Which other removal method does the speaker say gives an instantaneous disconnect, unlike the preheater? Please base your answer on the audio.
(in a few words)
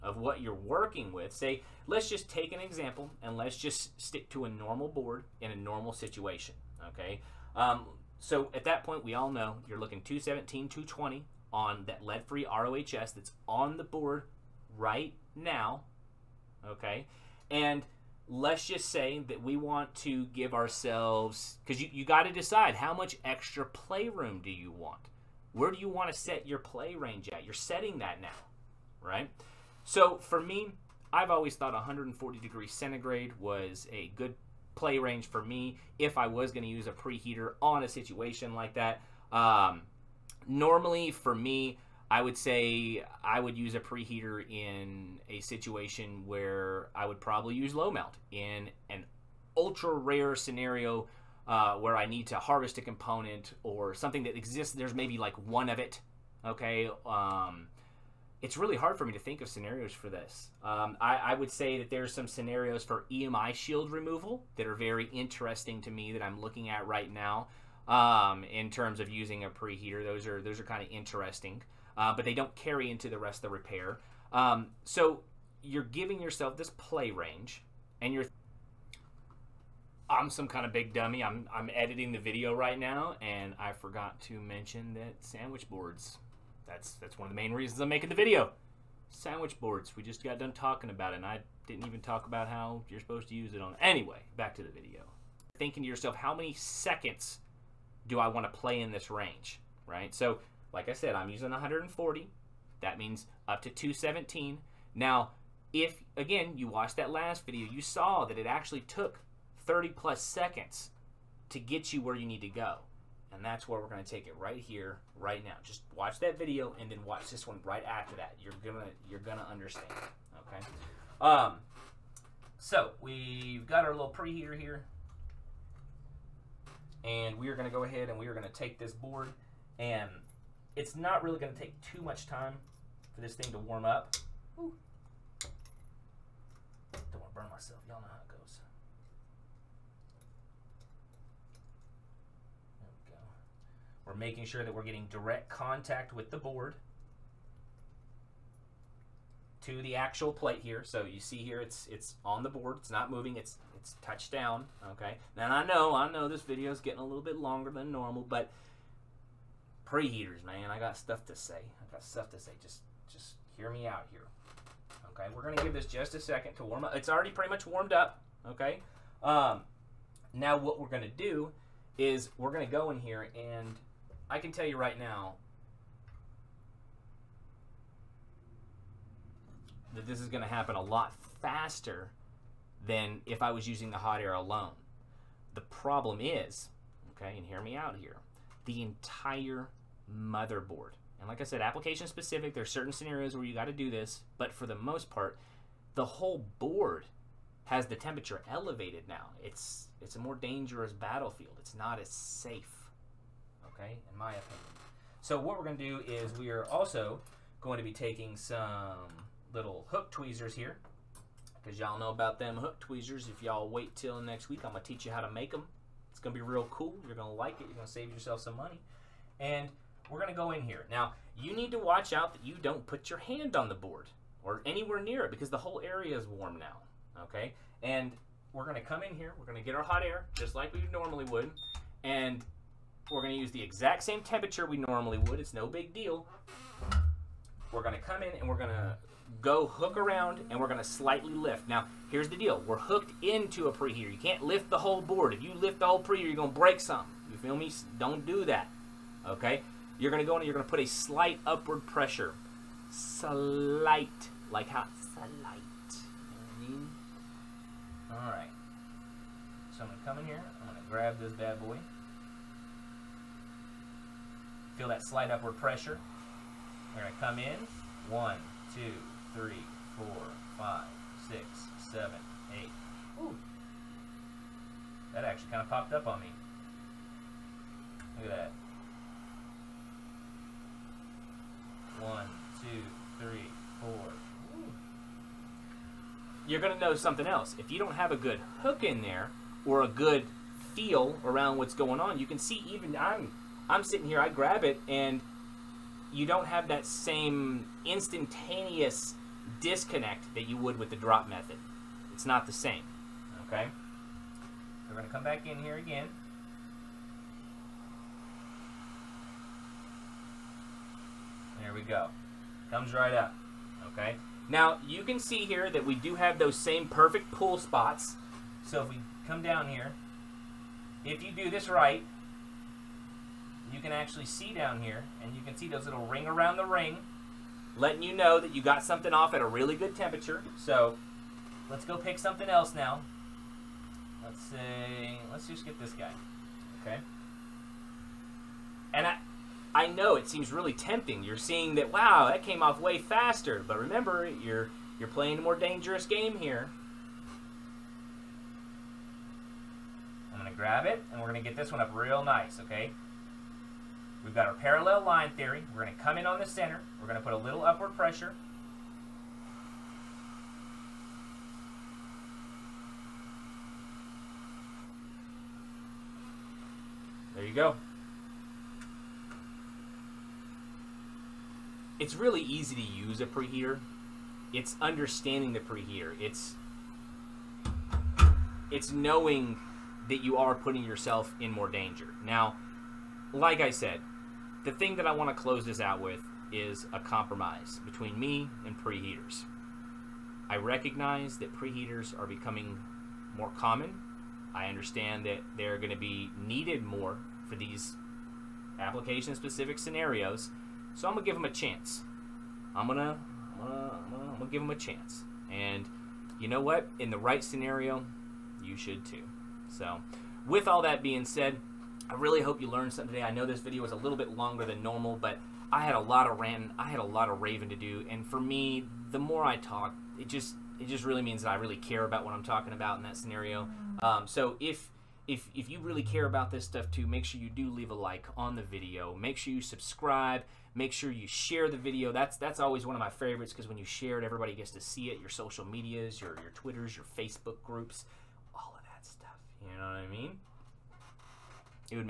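Drop method.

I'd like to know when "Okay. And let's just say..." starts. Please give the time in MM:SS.
00:16.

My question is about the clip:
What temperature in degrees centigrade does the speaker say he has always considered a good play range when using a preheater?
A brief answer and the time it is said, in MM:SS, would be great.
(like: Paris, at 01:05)
140, at 00:31.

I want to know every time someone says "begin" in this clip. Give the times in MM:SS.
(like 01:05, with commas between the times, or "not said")
not said.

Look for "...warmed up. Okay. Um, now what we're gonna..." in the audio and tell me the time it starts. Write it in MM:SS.
02:47.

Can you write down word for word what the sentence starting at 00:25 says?
Where do you want to set your play range at?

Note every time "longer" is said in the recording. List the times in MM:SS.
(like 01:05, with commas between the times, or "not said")
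02:37, 06:54.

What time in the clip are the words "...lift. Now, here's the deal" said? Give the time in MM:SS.
04:01.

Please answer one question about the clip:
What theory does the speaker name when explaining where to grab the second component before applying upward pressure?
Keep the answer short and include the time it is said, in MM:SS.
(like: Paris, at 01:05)
Parallel line theory, at 05:54.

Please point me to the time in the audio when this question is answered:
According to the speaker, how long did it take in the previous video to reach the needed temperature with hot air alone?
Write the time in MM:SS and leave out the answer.
01:49.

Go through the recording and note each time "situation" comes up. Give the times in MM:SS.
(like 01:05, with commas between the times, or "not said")
00:05, 00:37, 00:45.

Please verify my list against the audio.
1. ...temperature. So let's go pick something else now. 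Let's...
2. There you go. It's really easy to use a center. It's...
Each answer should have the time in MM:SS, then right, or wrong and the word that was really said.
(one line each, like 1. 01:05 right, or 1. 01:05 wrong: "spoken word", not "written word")
1. 05:29 right
2. 06:07 wrong: "preheater", not "center".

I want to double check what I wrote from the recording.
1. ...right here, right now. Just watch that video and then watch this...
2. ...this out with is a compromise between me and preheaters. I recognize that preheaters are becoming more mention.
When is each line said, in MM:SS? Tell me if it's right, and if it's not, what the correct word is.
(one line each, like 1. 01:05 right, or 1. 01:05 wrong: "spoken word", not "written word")
1. 01:54 right
2. 06:25 wrong: "common", not "mention".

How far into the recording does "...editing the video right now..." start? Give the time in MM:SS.
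01:21.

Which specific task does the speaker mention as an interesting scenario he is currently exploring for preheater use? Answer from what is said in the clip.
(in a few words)
EMI shield removal.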